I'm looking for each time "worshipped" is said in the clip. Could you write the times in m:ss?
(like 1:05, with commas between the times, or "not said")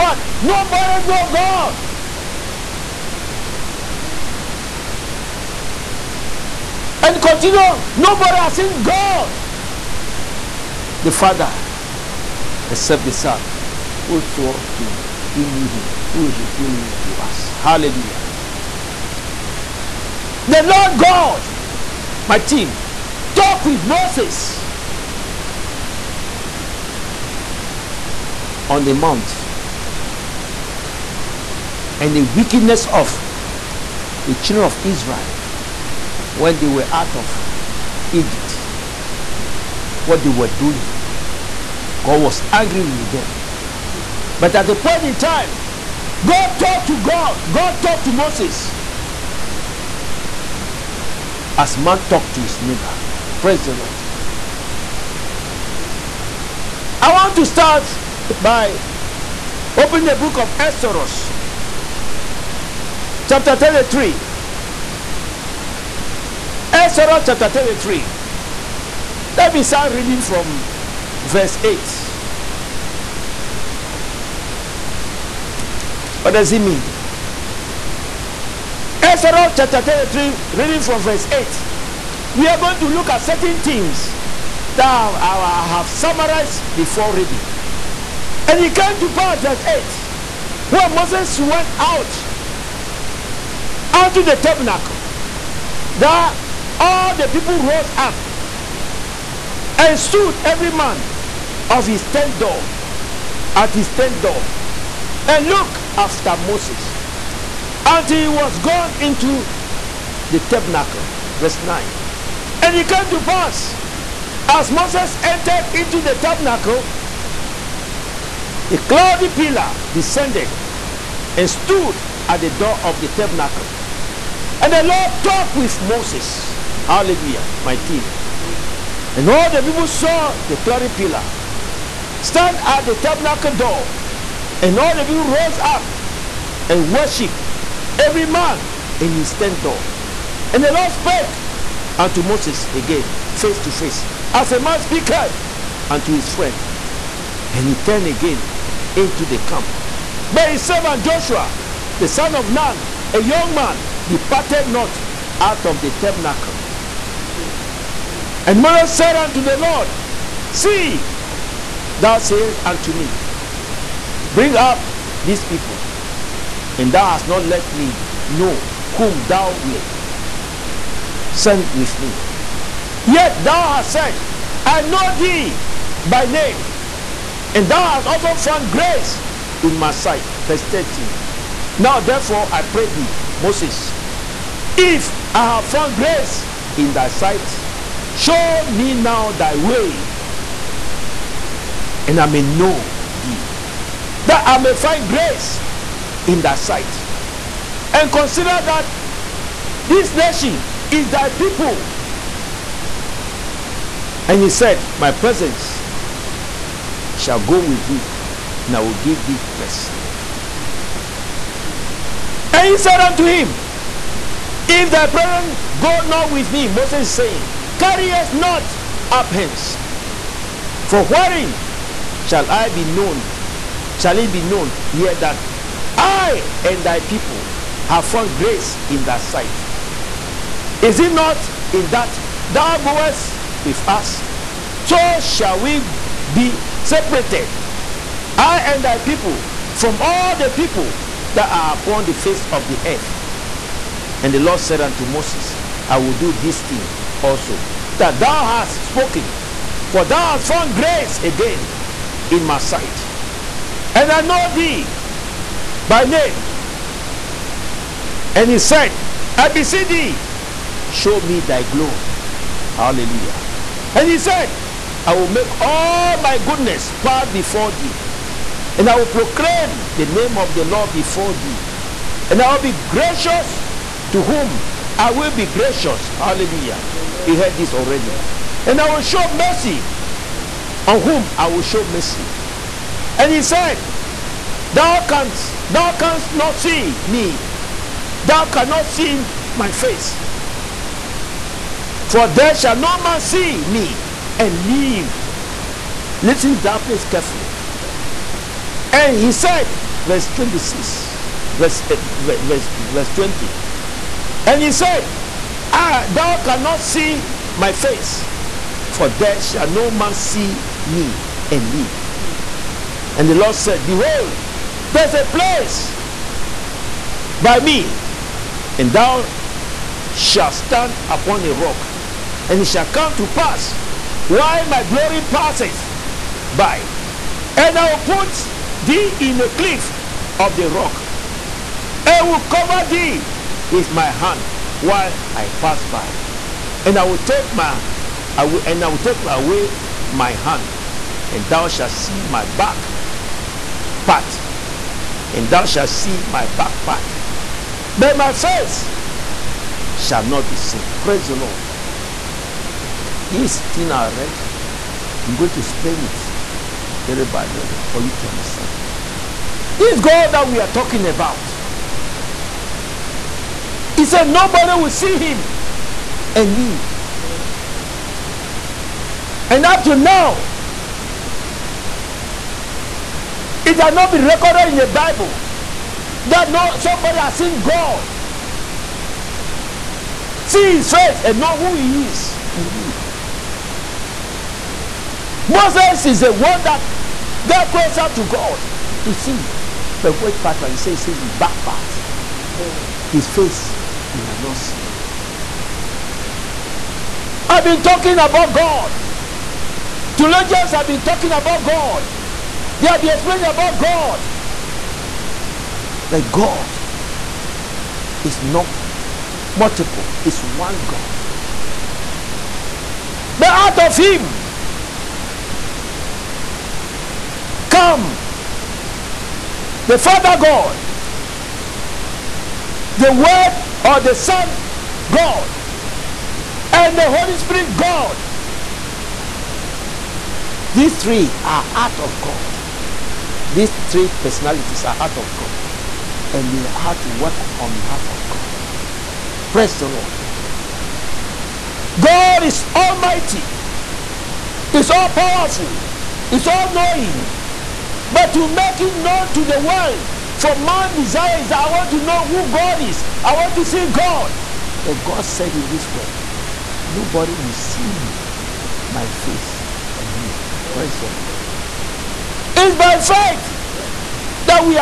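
2:16.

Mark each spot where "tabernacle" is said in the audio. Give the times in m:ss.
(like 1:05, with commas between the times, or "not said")
1:34, 1:50, 1:56, 2:03, 2:12, 2:35.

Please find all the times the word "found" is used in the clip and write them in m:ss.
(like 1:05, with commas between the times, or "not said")
2:58, 3:05, 3:48, 4:10.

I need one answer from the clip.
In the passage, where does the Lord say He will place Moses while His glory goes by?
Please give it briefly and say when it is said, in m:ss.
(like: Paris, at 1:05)
a cliff of the rock, at 5:29.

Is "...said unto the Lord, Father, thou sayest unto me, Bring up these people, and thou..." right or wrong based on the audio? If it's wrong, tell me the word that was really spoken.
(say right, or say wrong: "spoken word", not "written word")
wrong: "See", not "Father".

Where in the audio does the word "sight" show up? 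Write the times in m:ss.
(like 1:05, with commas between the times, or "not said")
2:59, 3:07, 3:16, 3:49, 4:12.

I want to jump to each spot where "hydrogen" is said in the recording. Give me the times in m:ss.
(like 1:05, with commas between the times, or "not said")
not said.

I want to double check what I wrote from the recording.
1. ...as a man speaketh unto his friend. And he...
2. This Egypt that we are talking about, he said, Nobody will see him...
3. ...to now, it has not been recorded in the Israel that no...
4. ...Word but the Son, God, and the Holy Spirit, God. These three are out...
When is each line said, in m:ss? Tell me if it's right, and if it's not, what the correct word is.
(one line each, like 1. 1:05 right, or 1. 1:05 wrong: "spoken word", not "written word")
1. 2:24 right
2. 5:59 wrong: "God", not "Egypt"
3. 6:09 wrong: "Bible", not "Israel"
4. 7:03 right.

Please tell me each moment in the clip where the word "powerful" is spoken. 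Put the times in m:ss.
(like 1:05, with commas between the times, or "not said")
7:25.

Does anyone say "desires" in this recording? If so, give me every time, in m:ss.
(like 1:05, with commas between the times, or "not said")
7:30.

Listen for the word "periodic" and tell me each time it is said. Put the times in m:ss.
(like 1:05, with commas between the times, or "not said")
not said.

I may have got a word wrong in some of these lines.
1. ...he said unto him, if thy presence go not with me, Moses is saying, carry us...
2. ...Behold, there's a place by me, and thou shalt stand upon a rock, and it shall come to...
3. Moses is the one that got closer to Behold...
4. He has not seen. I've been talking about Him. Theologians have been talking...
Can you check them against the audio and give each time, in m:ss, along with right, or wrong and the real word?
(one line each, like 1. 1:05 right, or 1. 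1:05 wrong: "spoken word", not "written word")
1. 3:32 right
2. 5:13 right
3. 6:25 wrong: "God", not "Behold"
4. 6:34 wrong: "God", not "Him".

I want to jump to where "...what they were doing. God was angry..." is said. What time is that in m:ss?
0:40.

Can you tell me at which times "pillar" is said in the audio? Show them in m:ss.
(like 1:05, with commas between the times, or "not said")
1:59, 2:10.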